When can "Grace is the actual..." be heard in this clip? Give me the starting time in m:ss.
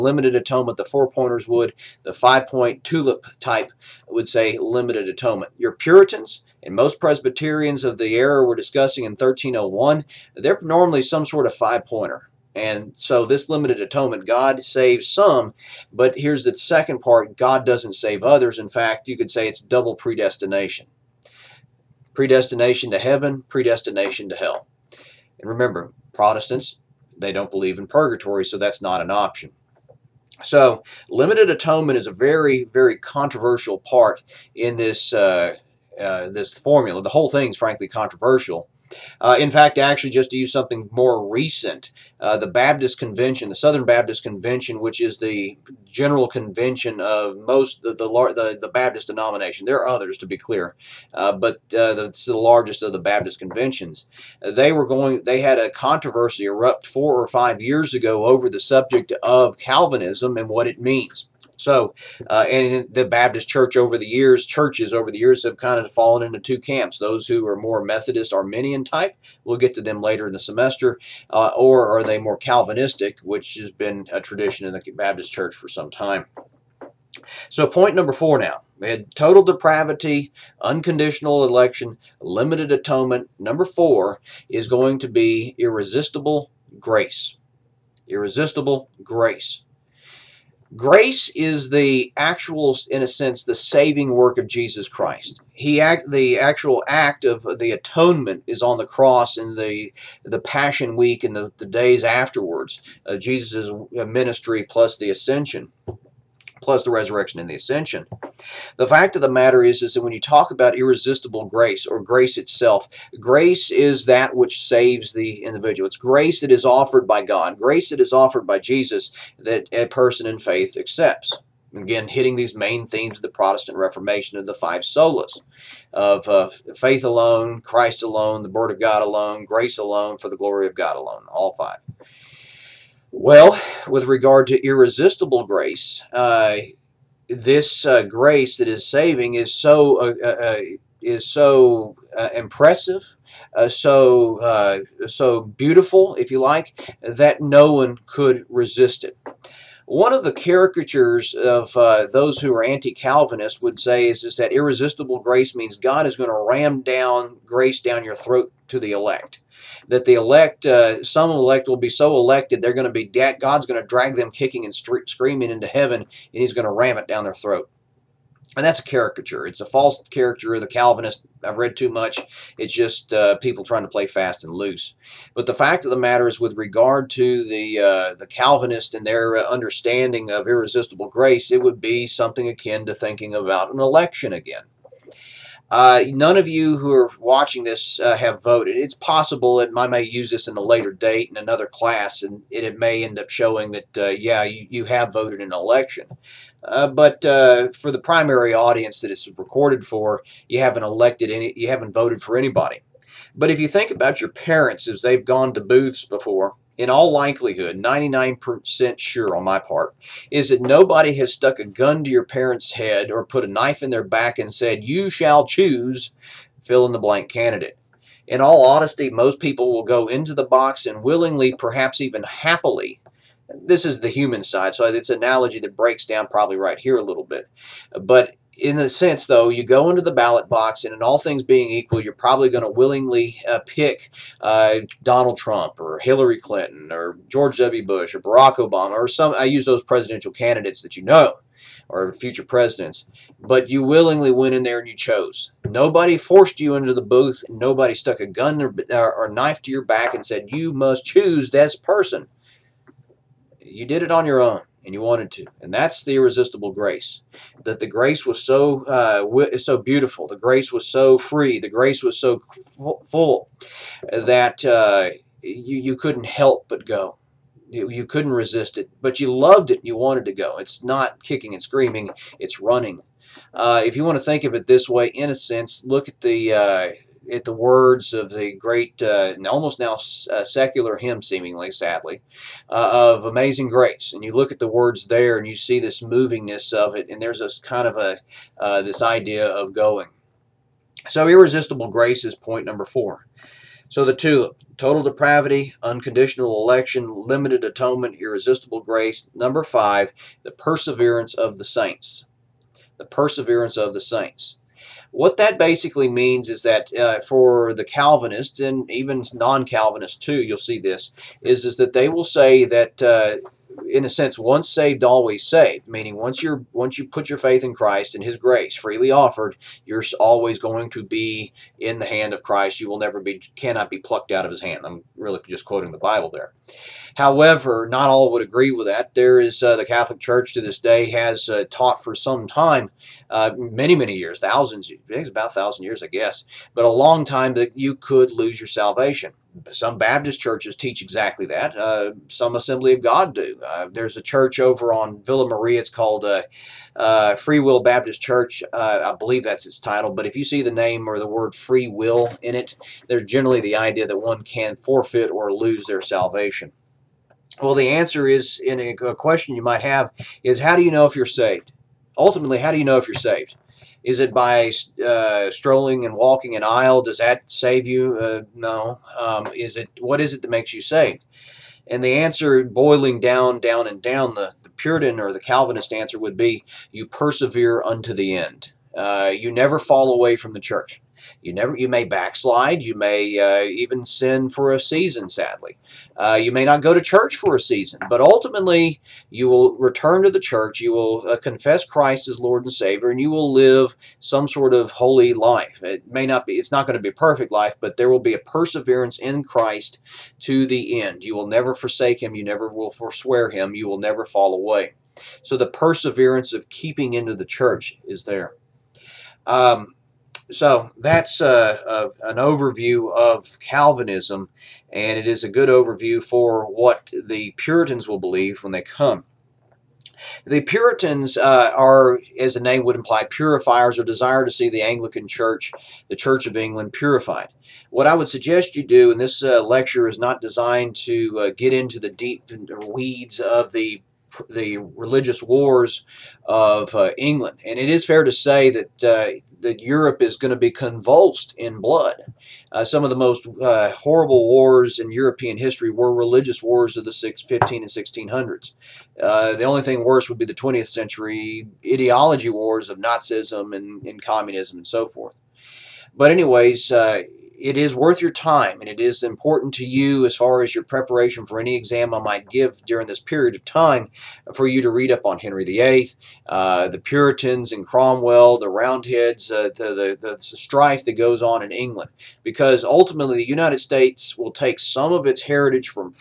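1:30.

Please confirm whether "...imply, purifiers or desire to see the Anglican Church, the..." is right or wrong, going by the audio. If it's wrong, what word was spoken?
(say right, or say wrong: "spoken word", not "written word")
right.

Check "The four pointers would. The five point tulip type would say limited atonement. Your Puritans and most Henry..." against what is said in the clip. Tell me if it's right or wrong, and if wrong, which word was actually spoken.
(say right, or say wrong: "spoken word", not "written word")
wrong: "Presbyterians", not "Henry".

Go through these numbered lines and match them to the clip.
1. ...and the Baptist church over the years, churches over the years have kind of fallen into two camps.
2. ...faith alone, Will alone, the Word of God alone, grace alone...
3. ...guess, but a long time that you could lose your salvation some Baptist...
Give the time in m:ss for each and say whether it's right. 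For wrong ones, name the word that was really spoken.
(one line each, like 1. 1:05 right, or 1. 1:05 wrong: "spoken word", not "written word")
1. 1:02 right
2. 2:06 wrong: "Christ", not "Will"
3. 5:36 right.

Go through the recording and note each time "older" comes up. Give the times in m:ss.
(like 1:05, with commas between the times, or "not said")
not said.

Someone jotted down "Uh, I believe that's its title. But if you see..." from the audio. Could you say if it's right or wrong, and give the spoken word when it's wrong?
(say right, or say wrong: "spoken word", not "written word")
right.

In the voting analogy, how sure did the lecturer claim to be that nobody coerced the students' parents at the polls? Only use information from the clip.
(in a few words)
99%.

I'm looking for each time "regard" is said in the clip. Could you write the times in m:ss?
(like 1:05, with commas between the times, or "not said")
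2:14, 2:56.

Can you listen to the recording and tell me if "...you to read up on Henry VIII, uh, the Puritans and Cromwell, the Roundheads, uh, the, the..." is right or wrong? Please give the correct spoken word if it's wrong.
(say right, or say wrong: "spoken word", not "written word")
right.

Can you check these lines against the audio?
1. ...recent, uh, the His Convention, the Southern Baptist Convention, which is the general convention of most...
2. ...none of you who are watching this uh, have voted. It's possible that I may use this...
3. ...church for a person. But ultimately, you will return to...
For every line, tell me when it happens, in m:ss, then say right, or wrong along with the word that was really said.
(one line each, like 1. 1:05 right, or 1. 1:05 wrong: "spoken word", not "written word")
1. 0:41 wrong: "Baptist", not "His"
2. 3:06 right
3. 6:26 wrong: "season", not "person".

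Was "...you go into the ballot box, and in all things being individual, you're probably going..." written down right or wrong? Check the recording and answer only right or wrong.
wrong.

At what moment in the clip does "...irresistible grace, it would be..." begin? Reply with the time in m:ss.
3:00.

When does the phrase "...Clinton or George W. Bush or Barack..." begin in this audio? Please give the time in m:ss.
3:56.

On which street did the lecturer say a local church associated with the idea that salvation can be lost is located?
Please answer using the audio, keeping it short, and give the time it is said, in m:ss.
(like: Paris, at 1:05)
Villa Maria, at 5:45.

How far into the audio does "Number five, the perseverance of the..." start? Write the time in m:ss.
4:59.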